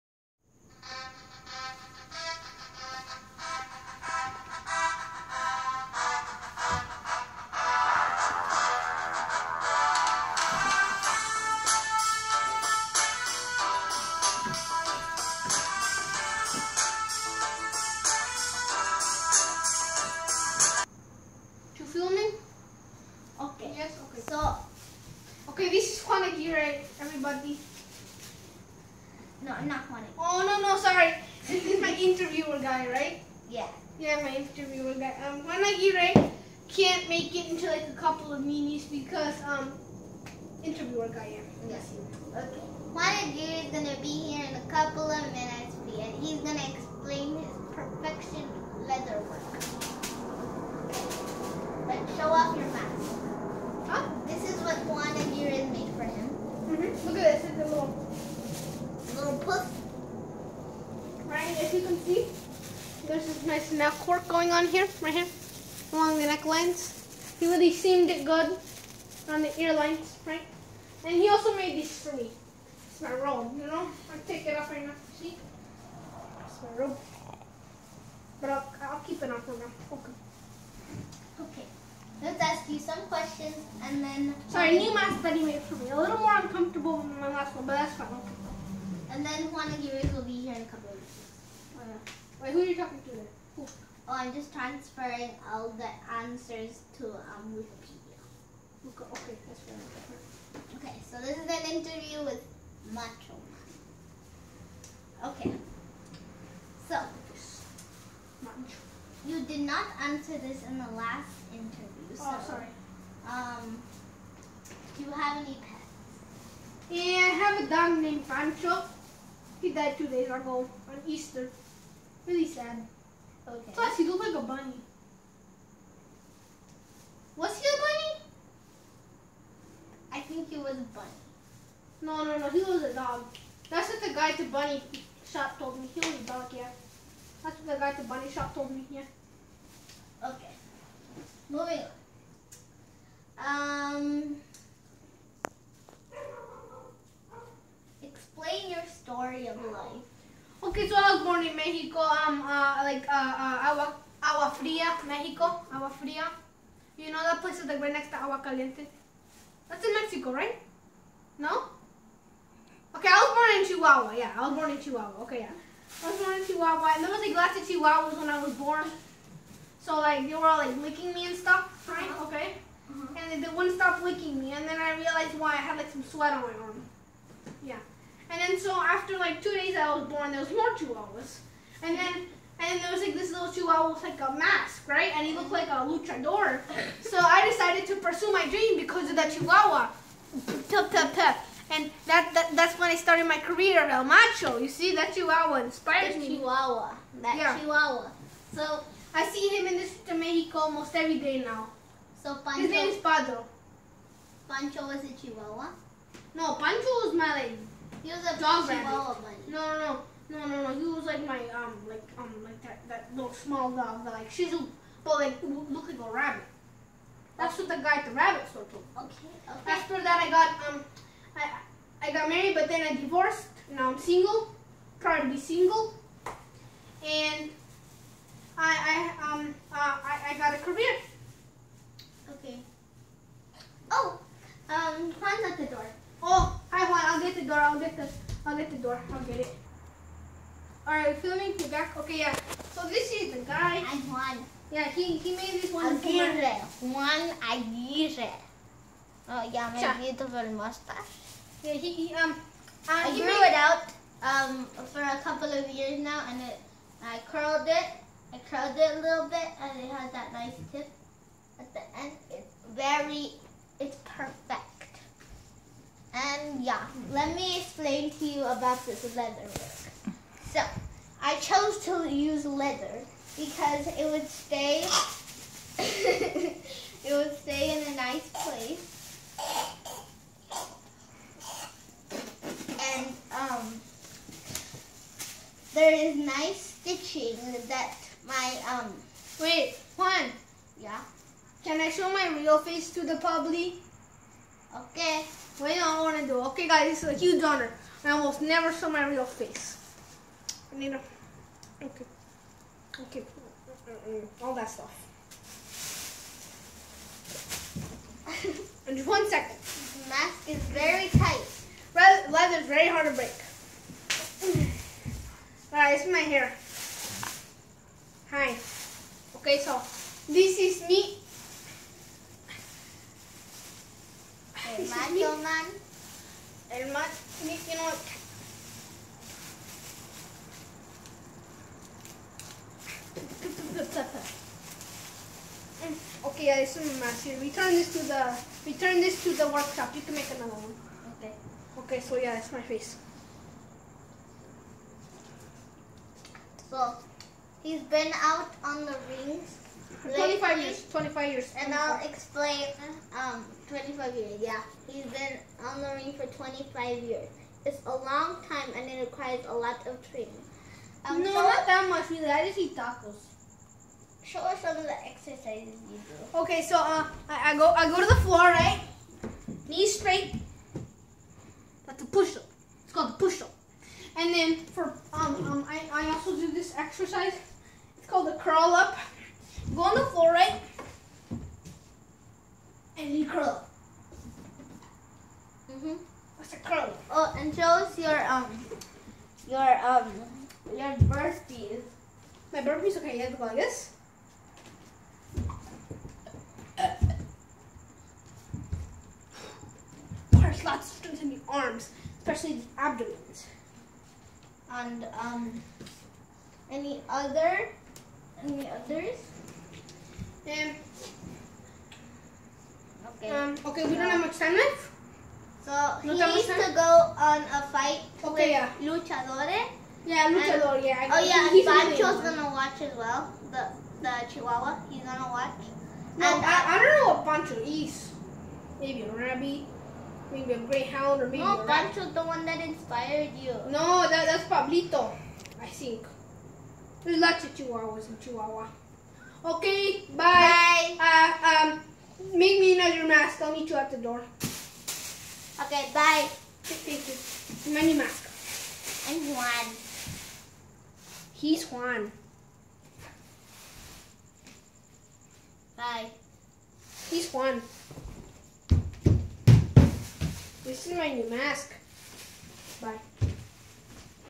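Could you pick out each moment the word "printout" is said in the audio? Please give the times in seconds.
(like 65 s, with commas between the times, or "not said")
not said.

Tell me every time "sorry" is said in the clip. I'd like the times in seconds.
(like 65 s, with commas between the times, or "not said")
30 s, 84 s, 112 s.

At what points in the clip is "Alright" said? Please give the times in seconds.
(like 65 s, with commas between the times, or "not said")
240 s, 315 s.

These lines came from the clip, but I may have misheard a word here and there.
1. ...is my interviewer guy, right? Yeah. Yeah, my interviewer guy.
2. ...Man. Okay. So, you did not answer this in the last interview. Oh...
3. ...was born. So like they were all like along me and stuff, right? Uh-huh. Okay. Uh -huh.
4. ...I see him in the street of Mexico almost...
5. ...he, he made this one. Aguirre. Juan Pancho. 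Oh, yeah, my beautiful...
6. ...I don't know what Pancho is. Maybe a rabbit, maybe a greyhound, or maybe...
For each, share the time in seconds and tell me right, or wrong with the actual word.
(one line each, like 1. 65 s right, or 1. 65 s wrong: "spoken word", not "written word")
1. 31 s right
2. 103 s right
3. 168 s wrong: "licking", not "along"
4. 199 s right
5. 244 s wrong: "Aguirre", not "Pancho"
6. 426 s right.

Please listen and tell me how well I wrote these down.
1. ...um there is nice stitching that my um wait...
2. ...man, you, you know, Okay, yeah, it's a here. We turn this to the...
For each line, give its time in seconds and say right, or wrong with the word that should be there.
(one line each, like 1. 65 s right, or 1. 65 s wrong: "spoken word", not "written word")
1. 283 s right
2. 326 s right.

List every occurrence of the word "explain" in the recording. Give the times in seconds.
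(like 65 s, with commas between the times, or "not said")
46 s, 352 s.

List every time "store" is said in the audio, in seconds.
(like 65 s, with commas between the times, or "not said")
218 s.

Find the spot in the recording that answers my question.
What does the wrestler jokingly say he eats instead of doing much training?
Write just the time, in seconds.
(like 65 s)
362 s.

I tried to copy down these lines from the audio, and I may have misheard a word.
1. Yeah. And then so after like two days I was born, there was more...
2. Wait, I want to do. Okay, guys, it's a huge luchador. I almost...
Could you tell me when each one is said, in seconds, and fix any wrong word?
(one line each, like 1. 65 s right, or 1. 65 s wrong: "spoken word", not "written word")
1. 177 s right
2. 295 s wrong: "honor", not "luchador".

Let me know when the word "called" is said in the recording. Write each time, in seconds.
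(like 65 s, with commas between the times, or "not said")
372 s, 378 s.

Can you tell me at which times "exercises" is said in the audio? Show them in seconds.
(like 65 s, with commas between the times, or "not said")
365 s, 376 s.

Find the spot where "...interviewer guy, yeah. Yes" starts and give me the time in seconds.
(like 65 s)
40 s.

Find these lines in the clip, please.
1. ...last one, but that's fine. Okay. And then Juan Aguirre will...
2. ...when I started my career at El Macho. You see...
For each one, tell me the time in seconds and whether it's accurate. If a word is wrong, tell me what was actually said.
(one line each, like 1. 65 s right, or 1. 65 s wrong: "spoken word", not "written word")
1. 87 s right
2. 192 s right.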